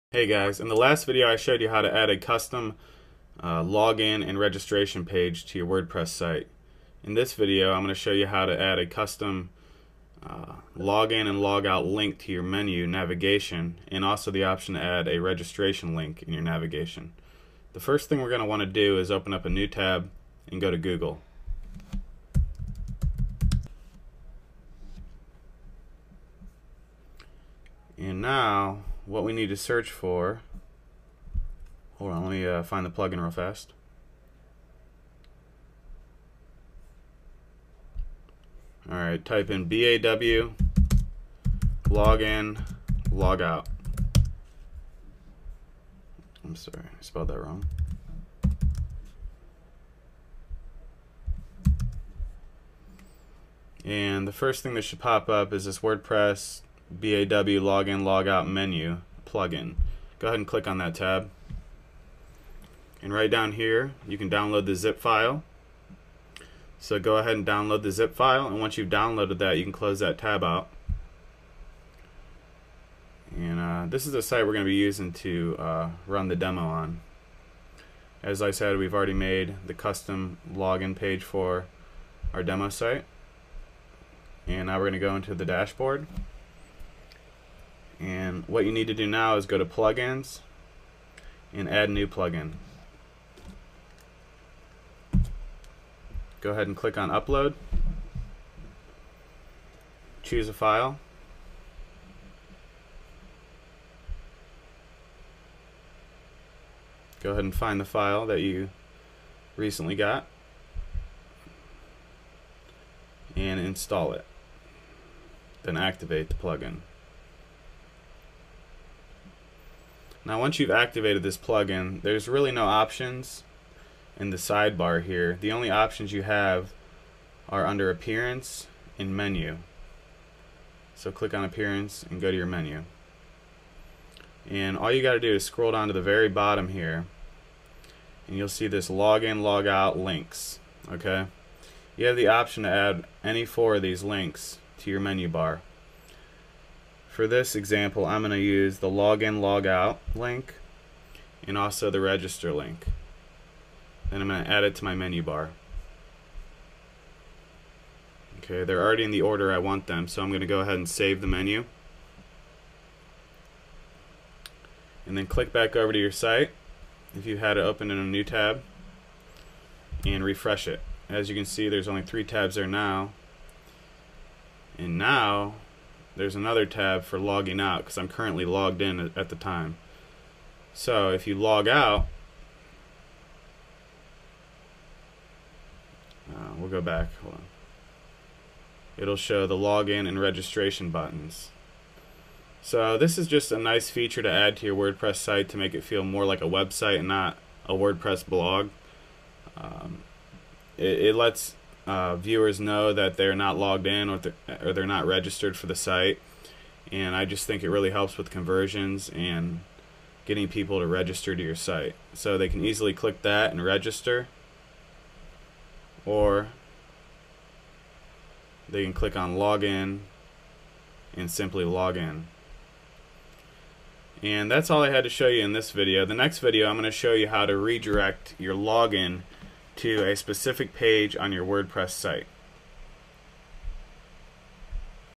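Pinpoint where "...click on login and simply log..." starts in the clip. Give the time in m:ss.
3:38.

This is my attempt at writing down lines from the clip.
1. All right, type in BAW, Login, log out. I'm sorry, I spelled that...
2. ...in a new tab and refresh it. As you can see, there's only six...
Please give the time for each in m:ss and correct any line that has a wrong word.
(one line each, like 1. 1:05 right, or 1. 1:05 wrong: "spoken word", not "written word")
1. 0:38 right
2. 2:47 wrong: "three", not "six".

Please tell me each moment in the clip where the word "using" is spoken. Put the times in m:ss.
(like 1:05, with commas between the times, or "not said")
1:14.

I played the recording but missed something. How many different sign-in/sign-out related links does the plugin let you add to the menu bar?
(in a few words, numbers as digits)
4.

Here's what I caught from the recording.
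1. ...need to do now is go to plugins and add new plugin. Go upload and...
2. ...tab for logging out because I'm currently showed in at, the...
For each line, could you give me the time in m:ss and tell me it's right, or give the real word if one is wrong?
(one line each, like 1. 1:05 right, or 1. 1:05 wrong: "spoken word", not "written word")
1. 1:28 wrong: "ahead", not "upload"
2. 2:56 wrong: "logged", not "showed".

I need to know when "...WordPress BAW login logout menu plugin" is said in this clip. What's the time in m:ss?
0:55.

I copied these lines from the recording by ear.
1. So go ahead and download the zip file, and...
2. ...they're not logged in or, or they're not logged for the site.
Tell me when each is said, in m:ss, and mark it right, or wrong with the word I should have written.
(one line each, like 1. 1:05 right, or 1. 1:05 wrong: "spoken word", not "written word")
1. 1:06 right
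2. 3:23 wrong: "registered", not "logged".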